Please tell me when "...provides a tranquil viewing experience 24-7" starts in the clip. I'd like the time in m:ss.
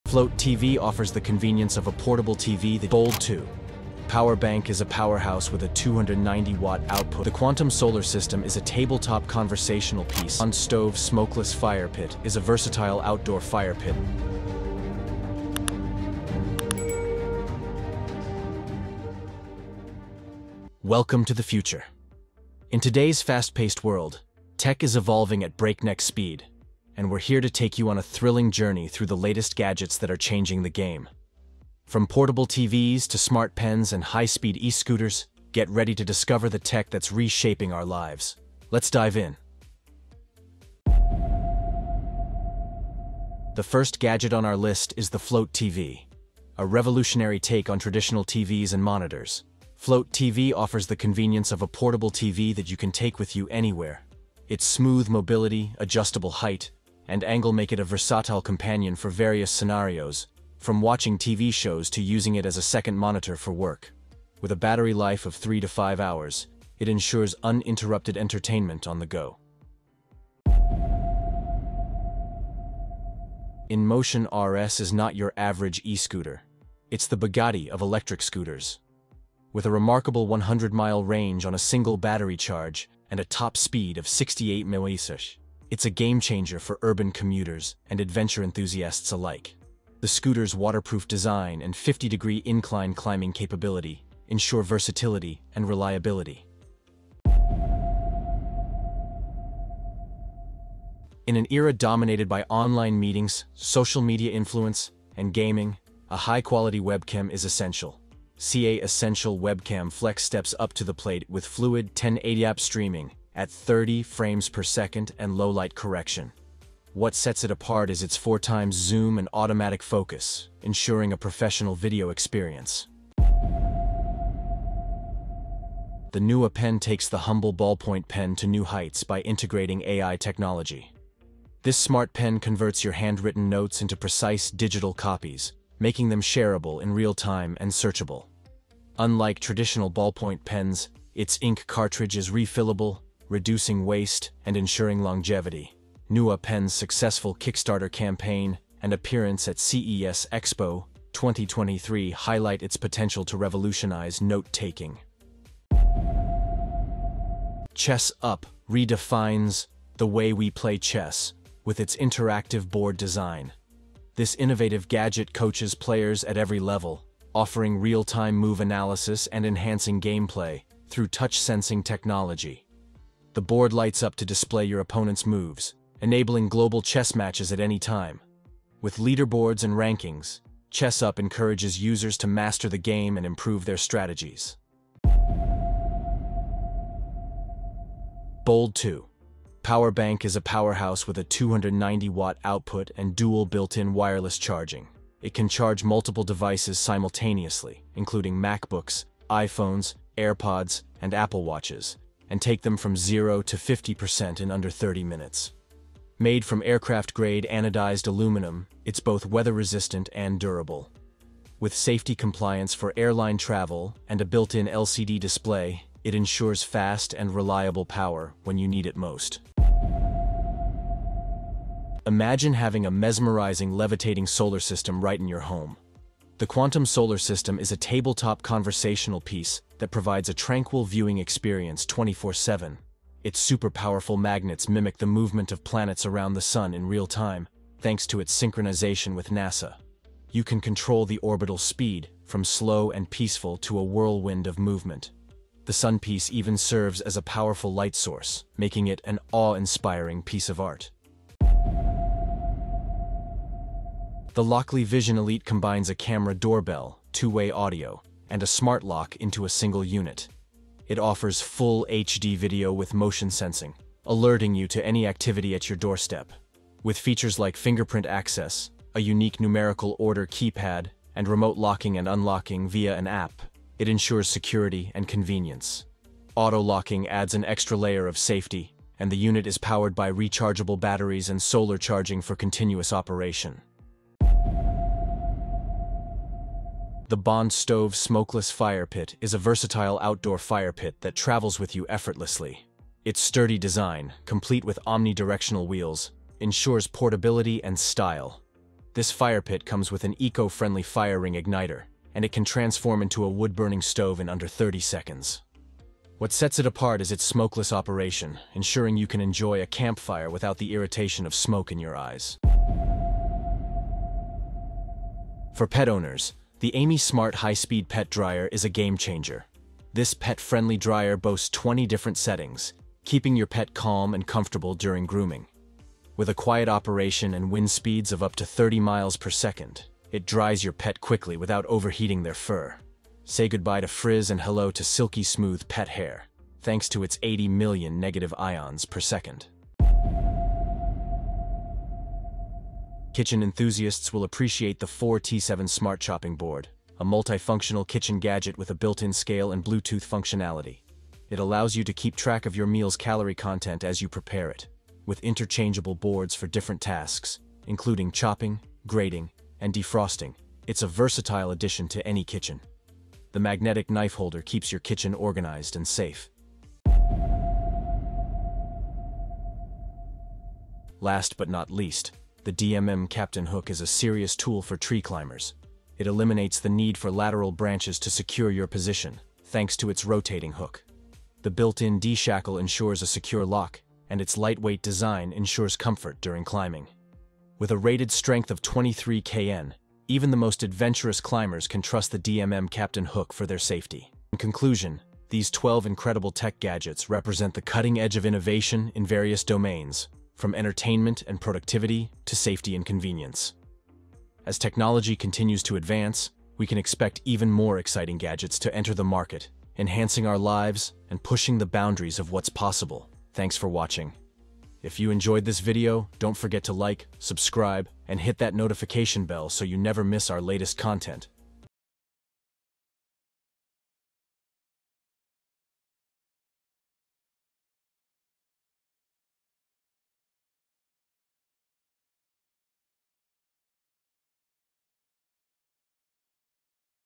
3:49.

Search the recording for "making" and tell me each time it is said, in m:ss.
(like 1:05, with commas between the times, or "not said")
2:15, 4:08.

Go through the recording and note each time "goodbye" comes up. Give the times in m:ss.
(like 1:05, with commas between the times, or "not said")
5:33.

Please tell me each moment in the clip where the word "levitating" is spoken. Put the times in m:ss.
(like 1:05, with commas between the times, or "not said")
3:43.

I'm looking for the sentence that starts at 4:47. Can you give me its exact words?
The Bond Stove Smokeless Fire Pit is a versatile outdoor fire pit that travels with you effortlessly.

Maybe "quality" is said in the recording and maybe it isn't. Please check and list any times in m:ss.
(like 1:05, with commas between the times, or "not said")
1:46.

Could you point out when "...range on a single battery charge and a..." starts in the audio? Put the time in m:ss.
1:21.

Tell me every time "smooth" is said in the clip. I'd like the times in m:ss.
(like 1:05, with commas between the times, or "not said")
0:54, 5:35.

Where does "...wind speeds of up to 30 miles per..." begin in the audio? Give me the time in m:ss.
5:27.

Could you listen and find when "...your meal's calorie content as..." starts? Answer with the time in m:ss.
5:52.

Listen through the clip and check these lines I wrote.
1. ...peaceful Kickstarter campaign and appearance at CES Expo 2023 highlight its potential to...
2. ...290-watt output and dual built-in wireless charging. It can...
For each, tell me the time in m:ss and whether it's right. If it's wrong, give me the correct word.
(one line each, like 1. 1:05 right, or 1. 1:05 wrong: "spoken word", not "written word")
1. 2:26 wrong: "successful", not "peaceful"
2. 3:11 right.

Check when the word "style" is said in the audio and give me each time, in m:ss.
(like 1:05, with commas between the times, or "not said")
4:57.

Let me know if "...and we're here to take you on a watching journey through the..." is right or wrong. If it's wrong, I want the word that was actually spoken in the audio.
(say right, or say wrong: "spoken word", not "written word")
wrong: "thrilling", not "watching".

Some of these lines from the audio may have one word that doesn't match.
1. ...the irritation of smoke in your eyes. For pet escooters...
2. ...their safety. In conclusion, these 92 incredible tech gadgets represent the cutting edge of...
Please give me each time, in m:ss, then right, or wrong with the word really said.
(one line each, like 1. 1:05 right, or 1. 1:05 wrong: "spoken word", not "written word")
1. 5:10 wrong: "owners", not "escooters"
2. 6:33 wrong: "12", not "92".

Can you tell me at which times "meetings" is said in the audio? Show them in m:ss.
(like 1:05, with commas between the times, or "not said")
1:42.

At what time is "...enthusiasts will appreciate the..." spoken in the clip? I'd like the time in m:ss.
5:43.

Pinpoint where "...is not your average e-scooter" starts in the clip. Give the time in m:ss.
1:14.